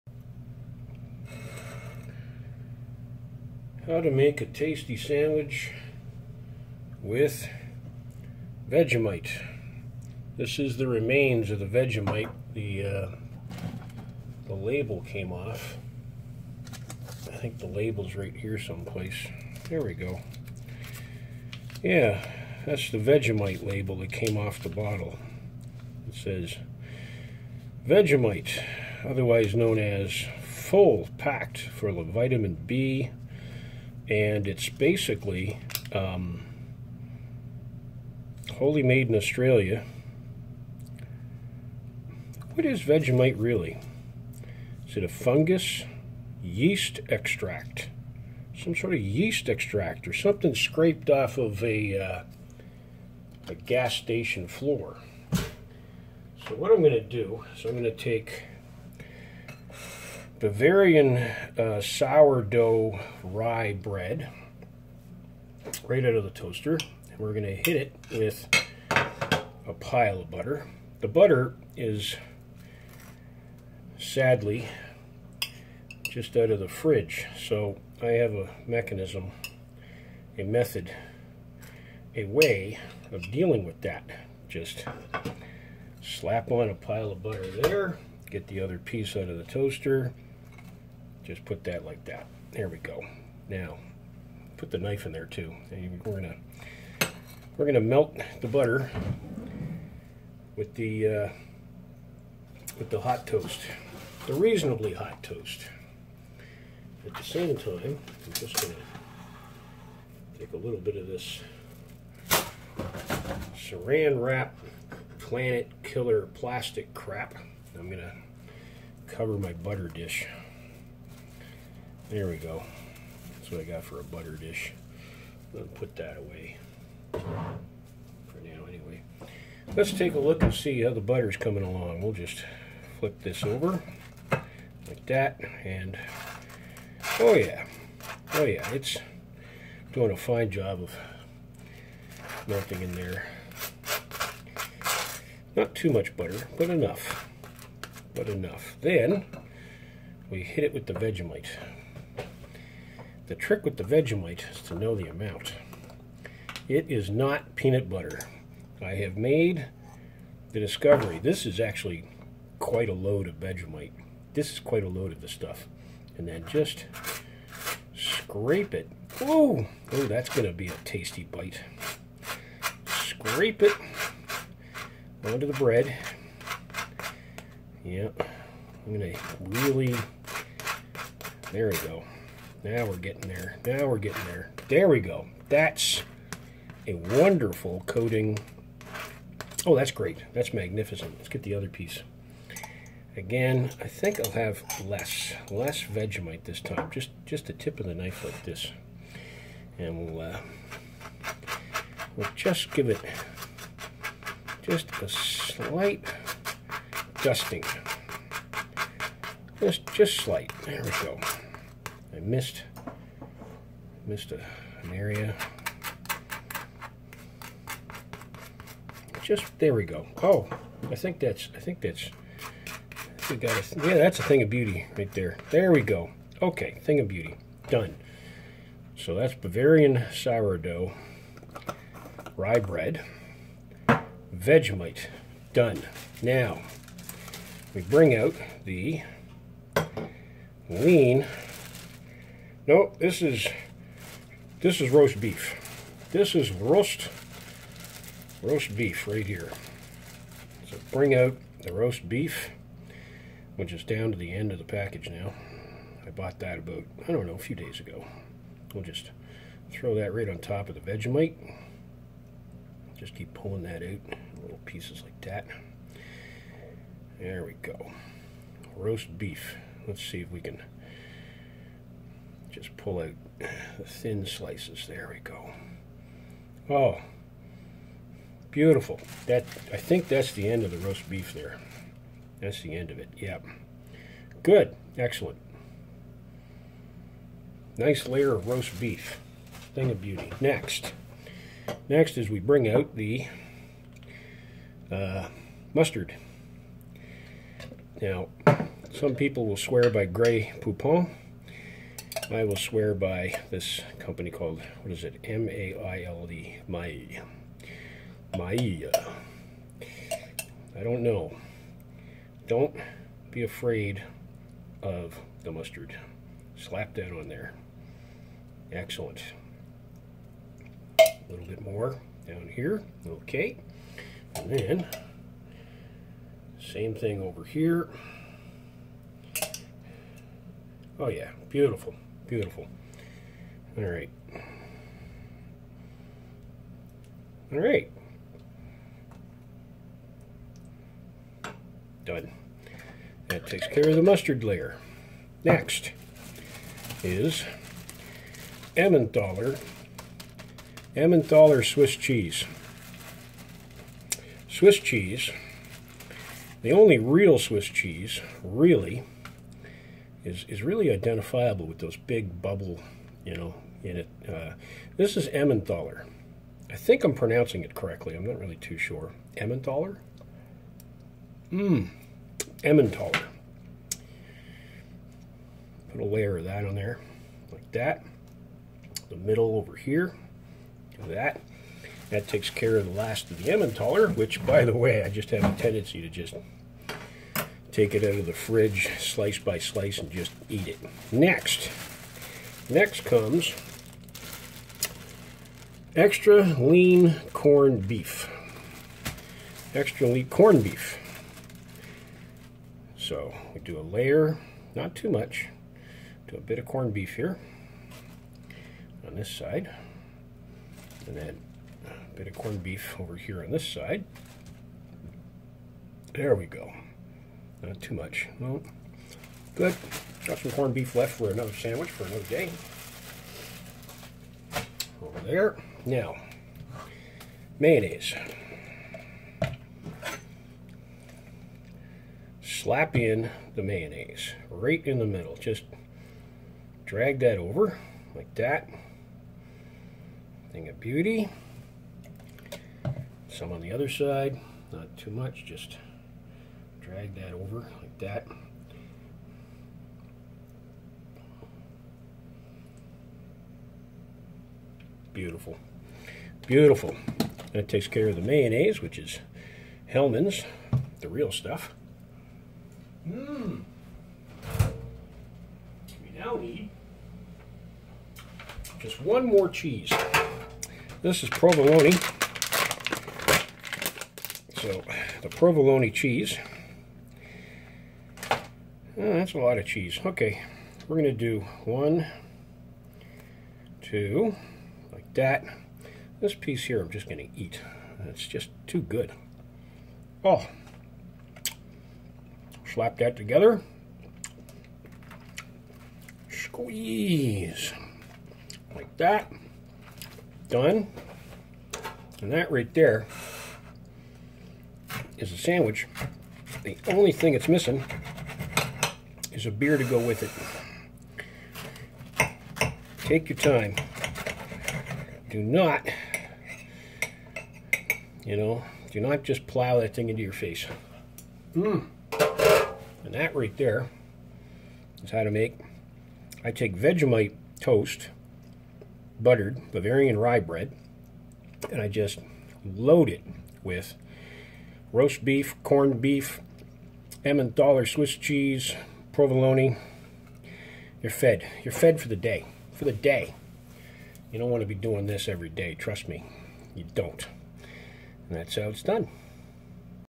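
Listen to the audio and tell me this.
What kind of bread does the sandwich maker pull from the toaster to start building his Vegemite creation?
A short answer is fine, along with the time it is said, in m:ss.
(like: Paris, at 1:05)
Bavarian sourdough rye, at 1:00.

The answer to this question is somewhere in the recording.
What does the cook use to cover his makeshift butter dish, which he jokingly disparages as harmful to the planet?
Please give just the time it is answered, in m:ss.
1:53.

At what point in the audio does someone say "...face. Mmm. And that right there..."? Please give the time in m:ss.
8:40.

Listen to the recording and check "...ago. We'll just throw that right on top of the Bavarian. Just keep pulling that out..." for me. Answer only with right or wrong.
wrong.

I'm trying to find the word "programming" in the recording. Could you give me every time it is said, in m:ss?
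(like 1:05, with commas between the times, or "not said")
not said.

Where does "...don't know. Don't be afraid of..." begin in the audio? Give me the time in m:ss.
5:10.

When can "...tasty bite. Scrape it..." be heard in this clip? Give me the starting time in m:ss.
2:50.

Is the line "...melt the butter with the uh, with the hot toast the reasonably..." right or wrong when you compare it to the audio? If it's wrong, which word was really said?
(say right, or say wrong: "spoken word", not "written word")
right.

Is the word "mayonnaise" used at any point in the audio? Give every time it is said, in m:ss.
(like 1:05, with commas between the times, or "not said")
7:07, 7:13, 7:38.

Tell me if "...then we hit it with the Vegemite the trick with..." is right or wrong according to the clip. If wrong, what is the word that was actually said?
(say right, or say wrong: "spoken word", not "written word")
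right.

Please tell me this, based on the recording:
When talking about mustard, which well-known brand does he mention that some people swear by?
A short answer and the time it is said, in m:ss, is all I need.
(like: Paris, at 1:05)
Grey Poupon, at 5:00.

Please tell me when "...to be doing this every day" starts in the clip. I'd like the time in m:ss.
9:04.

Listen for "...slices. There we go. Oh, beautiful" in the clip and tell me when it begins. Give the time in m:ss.
4:34.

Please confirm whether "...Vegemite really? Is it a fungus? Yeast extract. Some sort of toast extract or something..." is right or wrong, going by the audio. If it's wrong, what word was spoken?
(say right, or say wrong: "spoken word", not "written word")
wrong: "yeast", not "toast".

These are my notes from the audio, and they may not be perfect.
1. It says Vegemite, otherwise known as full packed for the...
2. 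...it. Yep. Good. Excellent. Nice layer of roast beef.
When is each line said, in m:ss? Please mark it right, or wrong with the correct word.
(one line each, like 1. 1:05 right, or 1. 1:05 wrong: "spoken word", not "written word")
1. 0:26 right
2. 4:42 right.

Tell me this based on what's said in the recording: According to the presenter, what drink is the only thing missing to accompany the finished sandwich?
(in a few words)
Beer.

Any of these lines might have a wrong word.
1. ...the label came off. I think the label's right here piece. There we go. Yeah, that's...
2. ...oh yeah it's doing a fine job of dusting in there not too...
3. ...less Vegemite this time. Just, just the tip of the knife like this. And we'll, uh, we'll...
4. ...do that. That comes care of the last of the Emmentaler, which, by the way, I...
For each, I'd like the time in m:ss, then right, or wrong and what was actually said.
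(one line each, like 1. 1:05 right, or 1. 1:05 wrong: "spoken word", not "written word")
1. 0:14 wrong: "someplace", not "piece"
2. 2:18 wrong: "melting", not "dusting"
3. 3:15 right
4. 6:21 wrong: "takes", not "comes".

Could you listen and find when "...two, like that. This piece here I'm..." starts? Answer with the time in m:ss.
8:03.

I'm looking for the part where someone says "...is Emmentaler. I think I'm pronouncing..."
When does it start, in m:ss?
6:05.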